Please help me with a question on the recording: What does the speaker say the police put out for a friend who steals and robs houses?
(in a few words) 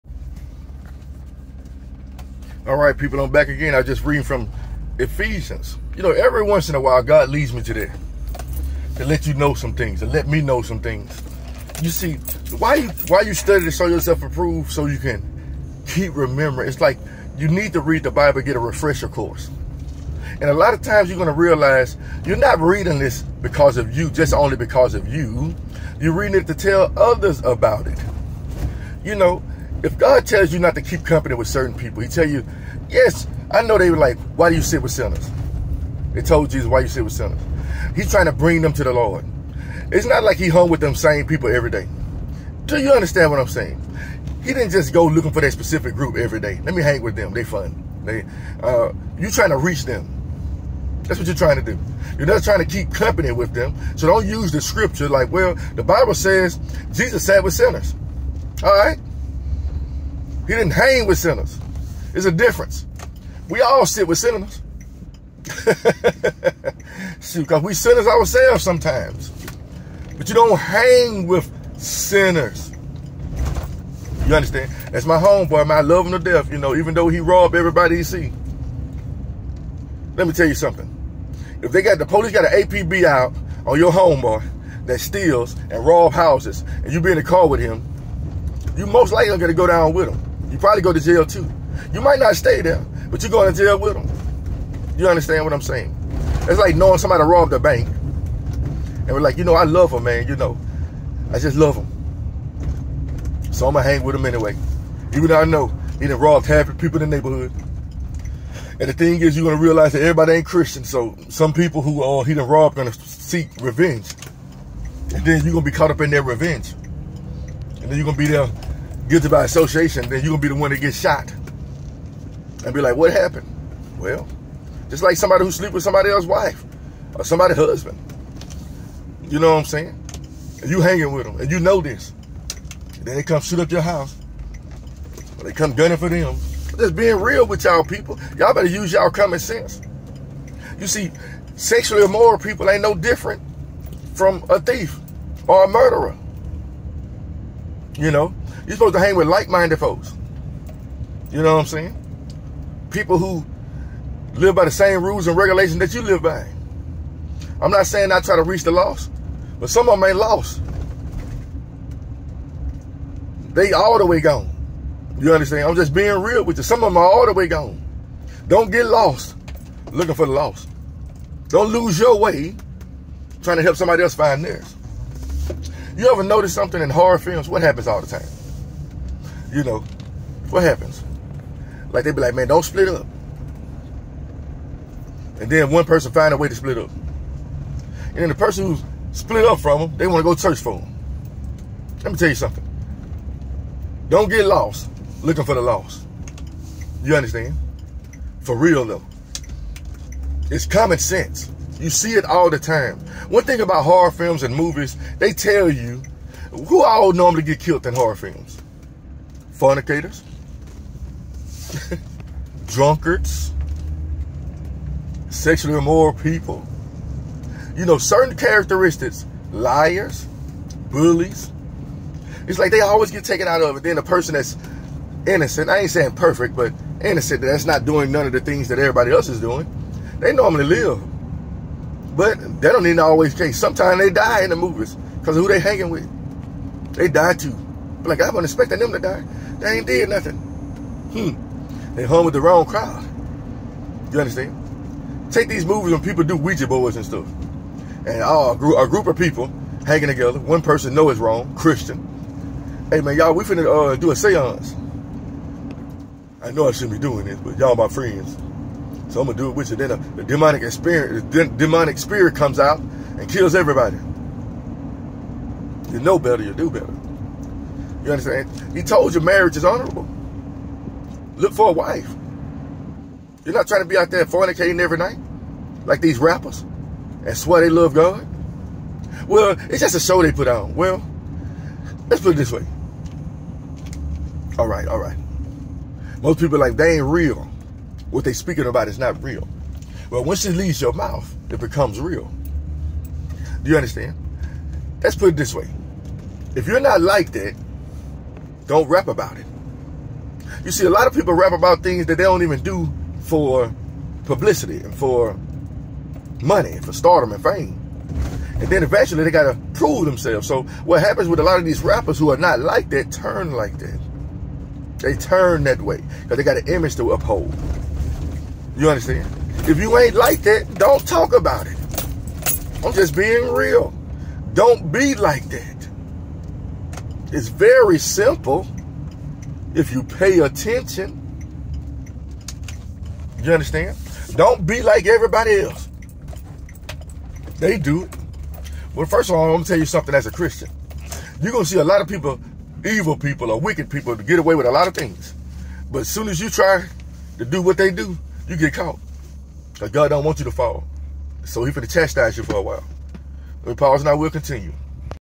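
An APB.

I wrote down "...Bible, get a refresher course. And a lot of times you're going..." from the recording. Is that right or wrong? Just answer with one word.
right.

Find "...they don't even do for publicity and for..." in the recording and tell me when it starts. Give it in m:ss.
5:02.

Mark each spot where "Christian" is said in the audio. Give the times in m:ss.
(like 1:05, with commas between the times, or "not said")
1:50, 4:11, 5:40.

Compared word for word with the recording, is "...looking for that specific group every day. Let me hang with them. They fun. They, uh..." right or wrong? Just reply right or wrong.
right.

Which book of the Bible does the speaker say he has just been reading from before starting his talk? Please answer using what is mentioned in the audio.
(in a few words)
Ephesians.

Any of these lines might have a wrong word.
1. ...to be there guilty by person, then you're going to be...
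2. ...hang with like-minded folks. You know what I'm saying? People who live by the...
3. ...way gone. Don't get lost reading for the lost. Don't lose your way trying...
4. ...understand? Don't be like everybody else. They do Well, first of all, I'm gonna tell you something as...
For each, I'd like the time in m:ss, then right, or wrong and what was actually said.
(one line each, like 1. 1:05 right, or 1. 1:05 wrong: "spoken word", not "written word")
1. 1:58 wrong: "association", not "person"
2. 2:28 right
3. 2:47 wrong: "looking", not "reading"
4. 5:33 right.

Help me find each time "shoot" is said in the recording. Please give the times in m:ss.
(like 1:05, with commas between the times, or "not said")
1:07, 2:13.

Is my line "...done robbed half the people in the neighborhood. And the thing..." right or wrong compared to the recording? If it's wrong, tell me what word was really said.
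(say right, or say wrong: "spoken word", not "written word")
right.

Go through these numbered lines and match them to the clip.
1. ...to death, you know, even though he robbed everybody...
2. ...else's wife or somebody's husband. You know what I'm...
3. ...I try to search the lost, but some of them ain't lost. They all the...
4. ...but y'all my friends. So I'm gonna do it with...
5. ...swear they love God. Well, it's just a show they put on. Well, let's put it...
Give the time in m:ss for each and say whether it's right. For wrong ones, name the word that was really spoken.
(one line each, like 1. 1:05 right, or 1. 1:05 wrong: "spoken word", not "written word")
1. 1:16 right
2. 2:06 right
3. 2:38 wrong: "reach", not "search"
4. 4:17 right
5. 4:37 right.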